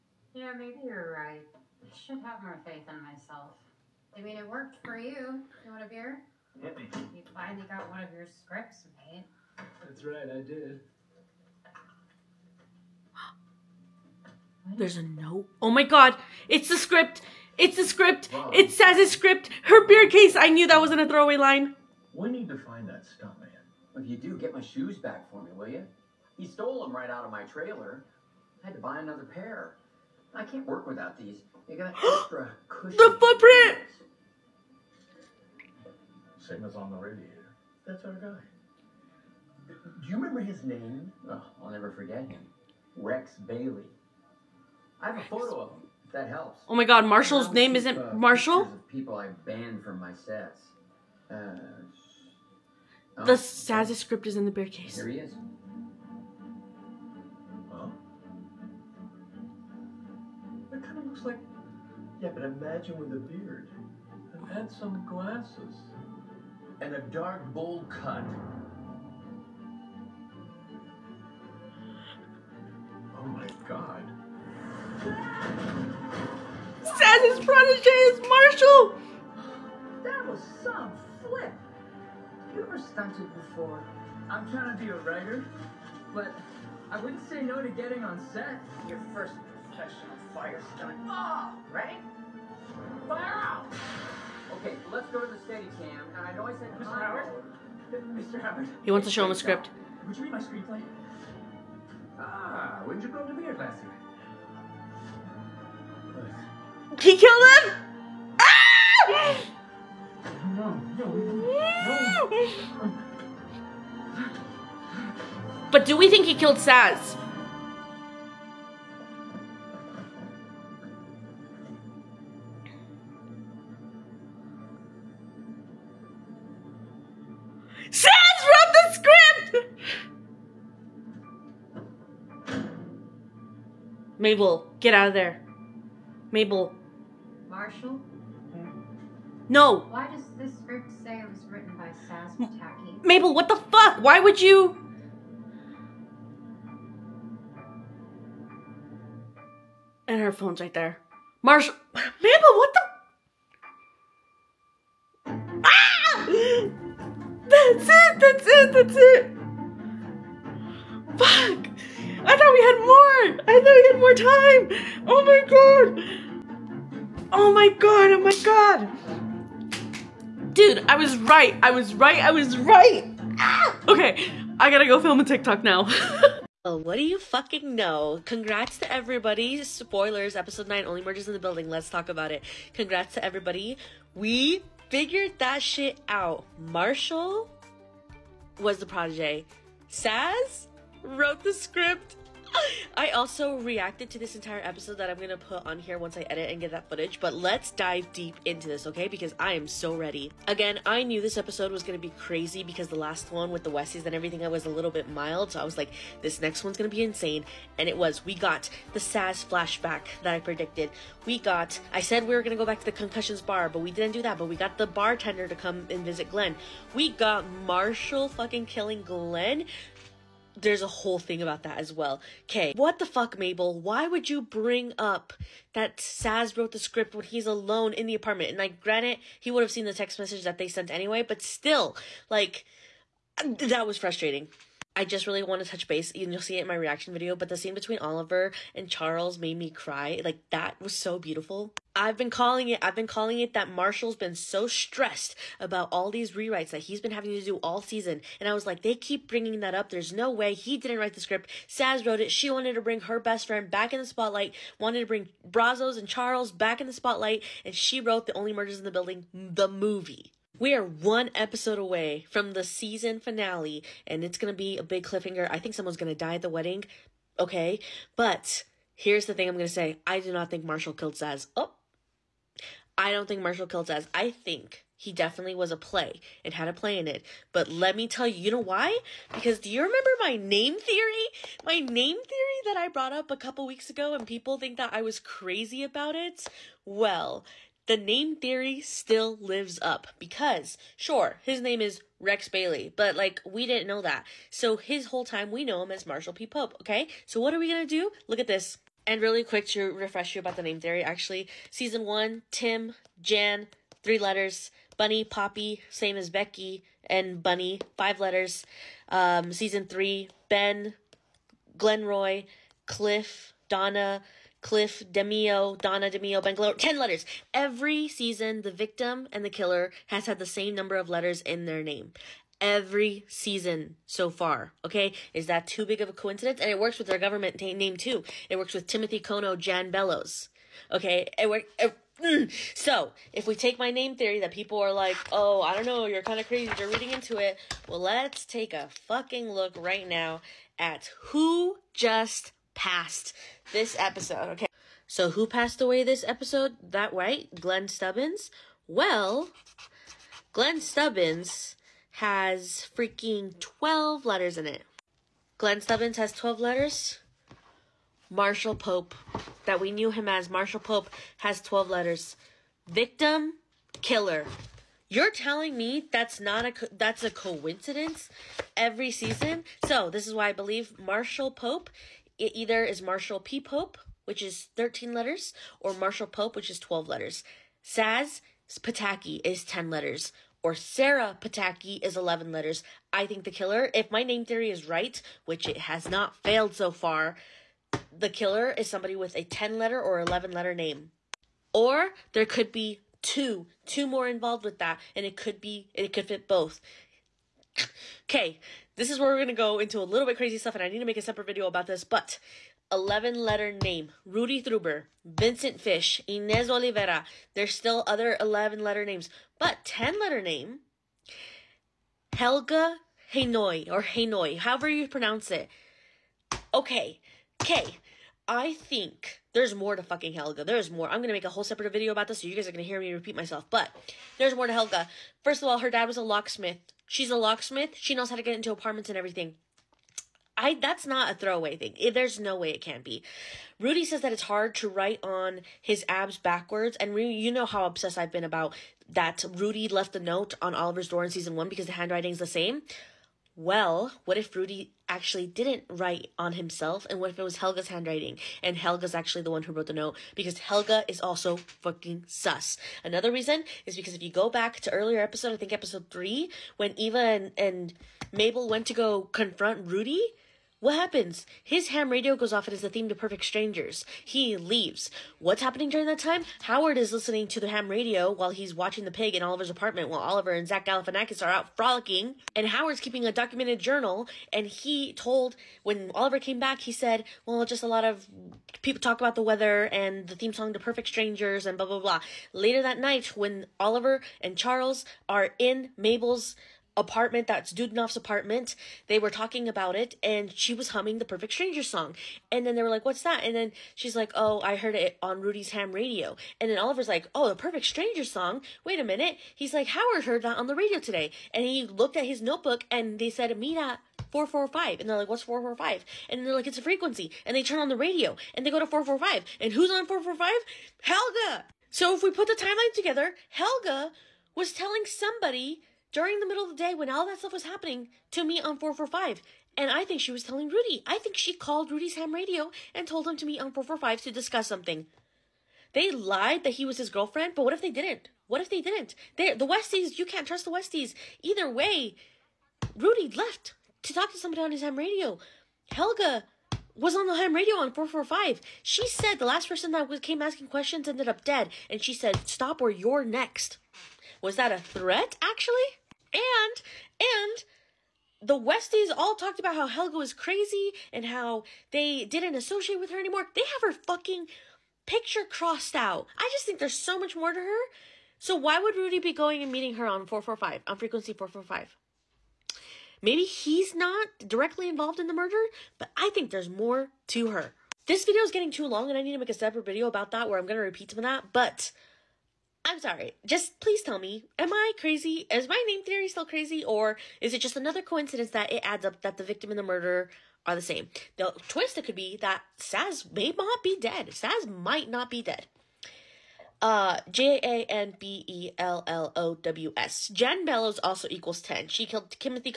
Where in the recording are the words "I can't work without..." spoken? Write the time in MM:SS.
00:30.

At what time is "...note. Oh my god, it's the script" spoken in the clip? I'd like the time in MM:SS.
00:15.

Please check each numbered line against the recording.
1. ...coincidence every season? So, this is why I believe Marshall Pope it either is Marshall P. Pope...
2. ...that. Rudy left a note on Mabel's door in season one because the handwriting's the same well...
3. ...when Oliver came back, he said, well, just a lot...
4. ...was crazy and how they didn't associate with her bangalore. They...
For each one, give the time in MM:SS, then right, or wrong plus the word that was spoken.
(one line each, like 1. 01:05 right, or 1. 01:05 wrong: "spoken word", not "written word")
1. 06:07 right
2. 07:19 wrong: "Oliver", not "Mabel"
3. 07:55 right
4. 09:10 wrong: "anymore", not "bangalore".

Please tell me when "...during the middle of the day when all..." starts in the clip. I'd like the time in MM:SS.
08:36.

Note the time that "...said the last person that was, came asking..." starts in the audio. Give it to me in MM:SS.
08:59.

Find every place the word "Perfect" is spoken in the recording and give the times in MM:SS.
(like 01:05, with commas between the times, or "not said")
07:43, 08:00, 08:11, 08:17.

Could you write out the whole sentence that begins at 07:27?
And what if it was Helga's handwriting?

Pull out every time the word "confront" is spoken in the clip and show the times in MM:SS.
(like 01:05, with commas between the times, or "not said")
07:39.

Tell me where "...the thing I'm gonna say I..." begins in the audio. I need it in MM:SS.
04:29.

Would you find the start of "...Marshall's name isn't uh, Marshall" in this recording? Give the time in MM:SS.
00:47.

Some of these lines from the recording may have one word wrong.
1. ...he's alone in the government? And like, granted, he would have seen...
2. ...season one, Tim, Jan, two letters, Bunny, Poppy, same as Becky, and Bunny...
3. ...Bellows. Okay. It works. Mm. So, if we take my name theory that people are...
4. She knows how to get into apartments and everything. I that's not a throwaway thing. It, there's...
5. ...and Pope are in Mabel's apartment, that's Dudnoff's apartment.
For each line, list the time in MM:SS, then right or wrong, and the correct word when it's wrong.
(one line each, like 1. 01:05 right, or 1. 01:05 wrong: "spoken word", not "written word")
1. 03:47 wrong: "apartment", not "government"
2. 05:01 wrong: "three", not "two"
3. 05:29 right
4. 07:07 right
5. 08:04 wrong: "Charles", not "Pope".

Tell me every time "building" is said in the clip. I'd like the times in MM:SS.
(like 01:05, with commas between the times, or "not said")
03:01, 04:18.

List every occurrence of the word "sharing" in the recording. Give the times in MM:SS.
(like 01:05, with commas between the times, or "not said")
not said.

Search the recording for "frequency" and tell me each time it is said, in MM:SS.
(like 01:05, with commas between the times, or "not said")
08:26, 09:20.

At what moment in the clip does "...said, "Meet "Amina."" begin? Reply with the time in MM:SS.
08:23.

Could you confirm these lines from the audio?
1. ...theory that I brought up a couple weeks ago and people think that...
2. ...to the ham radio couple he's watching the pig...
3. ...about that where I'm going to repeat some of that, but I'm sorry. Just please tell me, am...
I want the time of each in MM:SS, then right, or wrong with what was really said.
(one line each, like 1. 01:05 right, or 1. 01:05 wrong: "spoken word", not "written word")
1. 04:42 right
2. 07:47 wrong: "while", not "couple"
3. 09:30 right.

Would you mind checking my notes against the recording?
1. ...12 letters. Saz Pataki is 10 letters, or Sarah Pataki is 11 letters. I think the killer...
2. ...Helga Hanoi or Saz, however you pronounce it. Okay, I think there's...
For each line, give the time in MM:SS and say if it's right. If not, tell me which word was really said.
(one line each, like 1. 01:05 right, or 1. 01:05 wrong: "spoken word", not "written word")
1. 06:16 right
2. 06:52 wrong: "Hanoi", not "Saz".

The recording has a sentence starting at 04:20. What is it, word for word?
We are one episode away from the season finale, and it's gonna be a big cliffhanger.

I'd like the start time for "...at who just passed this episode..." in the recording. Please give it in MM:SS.
05:40.